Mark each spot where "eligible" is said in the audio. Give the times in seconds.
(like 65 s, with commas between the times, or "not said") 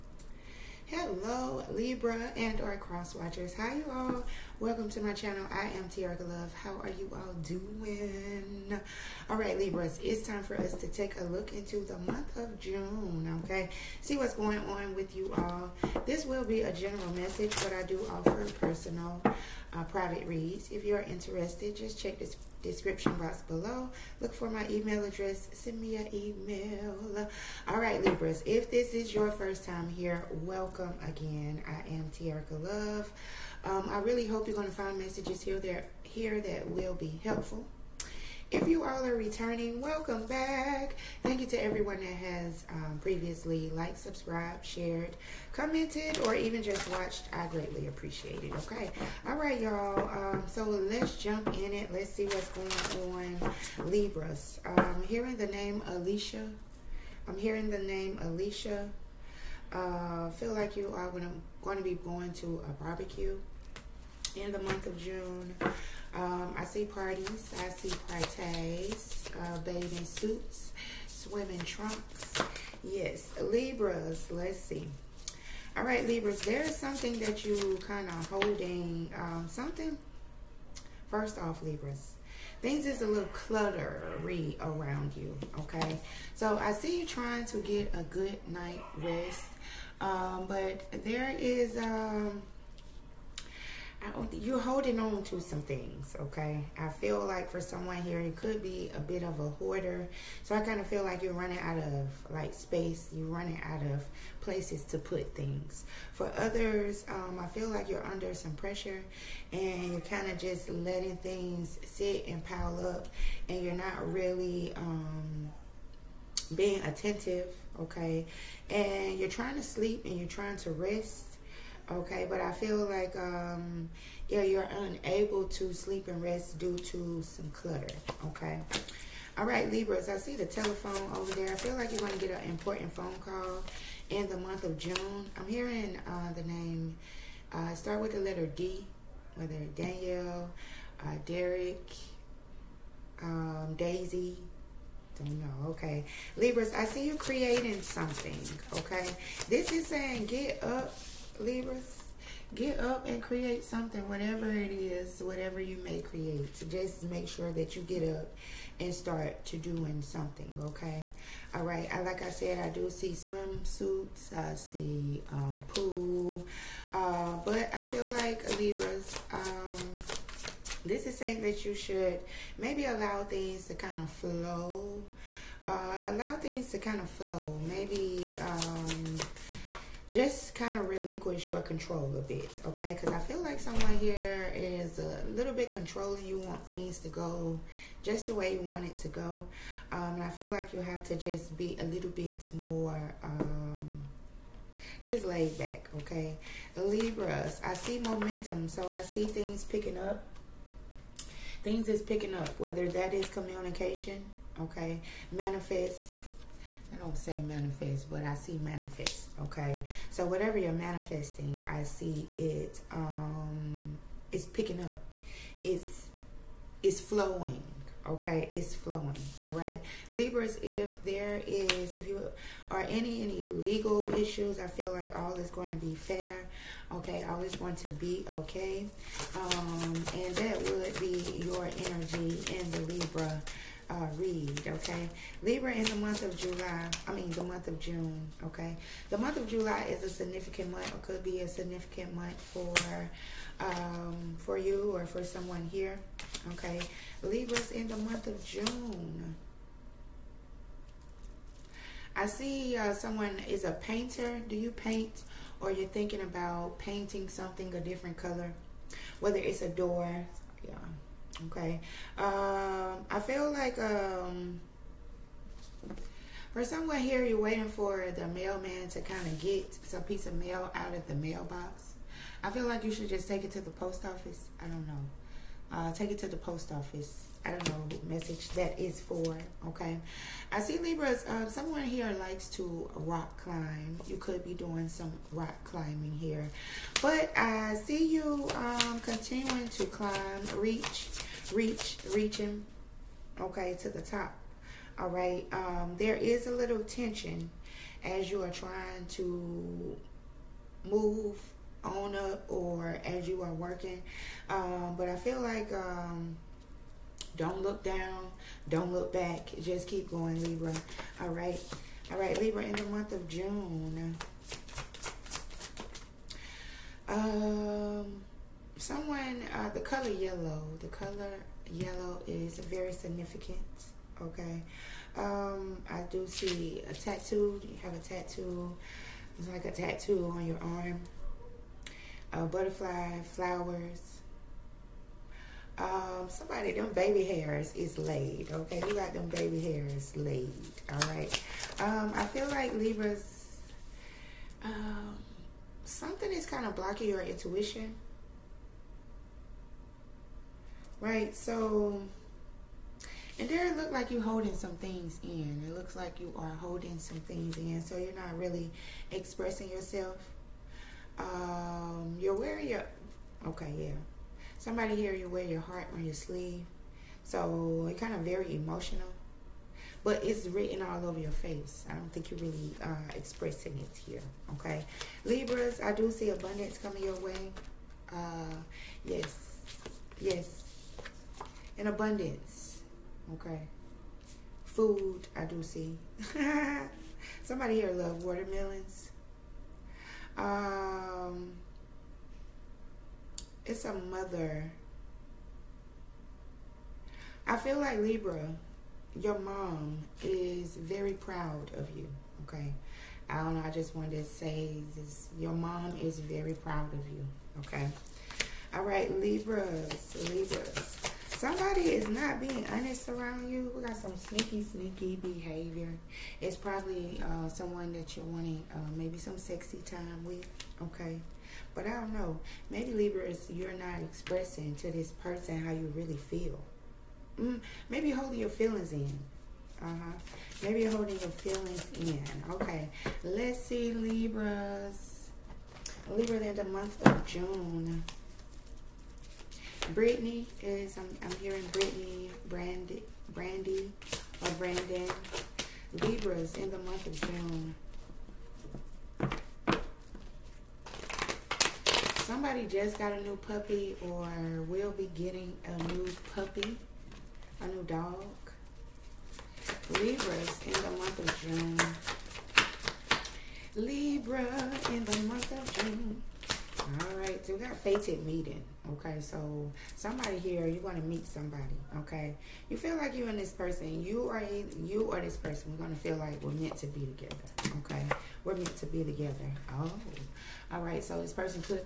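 not said.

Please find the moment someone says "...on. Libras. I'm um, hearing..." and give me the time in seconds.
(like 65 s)
53 s.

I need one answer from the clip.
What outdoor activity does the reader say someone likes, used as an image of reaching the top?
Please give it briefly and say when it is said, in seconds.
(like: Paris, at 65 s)
Rock climbing, at 282 s.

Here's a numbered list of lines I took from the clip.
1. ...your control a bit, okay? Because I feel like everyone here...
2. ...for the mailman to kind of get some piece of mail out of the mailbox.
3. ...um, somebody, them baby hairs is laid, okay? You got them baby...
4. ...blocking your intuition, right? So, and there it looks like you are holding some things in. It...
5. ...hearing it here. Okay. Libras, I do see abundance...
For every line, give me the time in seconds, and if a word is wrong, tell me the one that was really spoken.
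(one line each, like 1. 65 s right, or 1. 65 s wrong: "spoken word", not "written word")
1. 181 s wrong: "someone", not "everyone"
2. 267 s right
3. 335 s right
4. 346 s right
5. 373 s wrong: "expressing", not "hearing".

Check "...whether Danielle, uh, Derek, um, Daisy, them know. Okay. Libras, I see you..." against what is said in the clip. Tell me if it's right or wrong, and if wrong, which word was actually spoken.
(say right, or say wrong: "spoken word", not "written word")
right.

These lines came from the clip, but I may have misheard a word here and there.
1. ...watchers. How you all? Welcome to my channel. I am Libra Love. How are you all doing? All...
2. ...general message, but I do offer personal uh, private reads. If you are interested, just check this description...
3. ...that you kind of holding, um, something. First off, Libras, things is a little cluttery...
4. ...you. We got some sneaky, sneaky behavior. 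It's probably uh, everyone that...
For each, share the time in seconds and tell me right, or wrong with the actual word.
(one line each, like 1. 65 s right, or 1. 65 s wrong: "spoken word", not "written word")
1. 3 s wrong: "Tericka", not "Libra"
2. 16 s right
3. 77 s right
4. 413 s wrong: "someone", not "everyone".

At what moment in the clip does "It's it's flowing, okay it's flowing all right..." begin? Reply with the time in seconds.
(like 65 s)
215 s.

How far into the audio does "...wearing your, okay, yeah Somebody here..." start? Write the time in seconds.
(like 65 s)
362 s.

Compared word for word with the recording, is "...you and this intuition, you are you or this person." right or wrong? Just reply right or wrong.
wrong.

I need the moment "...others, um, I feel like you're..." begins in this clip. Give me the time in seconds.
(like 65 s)
106 s.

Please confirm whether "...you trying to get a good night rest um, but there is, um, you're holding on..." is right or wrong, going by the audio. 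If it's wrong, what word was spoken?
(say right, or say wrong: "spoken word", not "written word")
right.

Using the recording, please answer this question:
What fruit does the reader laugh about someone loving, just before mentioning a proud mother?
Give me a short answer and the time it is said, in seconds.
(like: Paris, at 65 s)
Watermelons, at 388 s.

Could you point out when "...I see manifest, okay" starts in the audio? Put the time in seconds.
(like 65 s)
208 s.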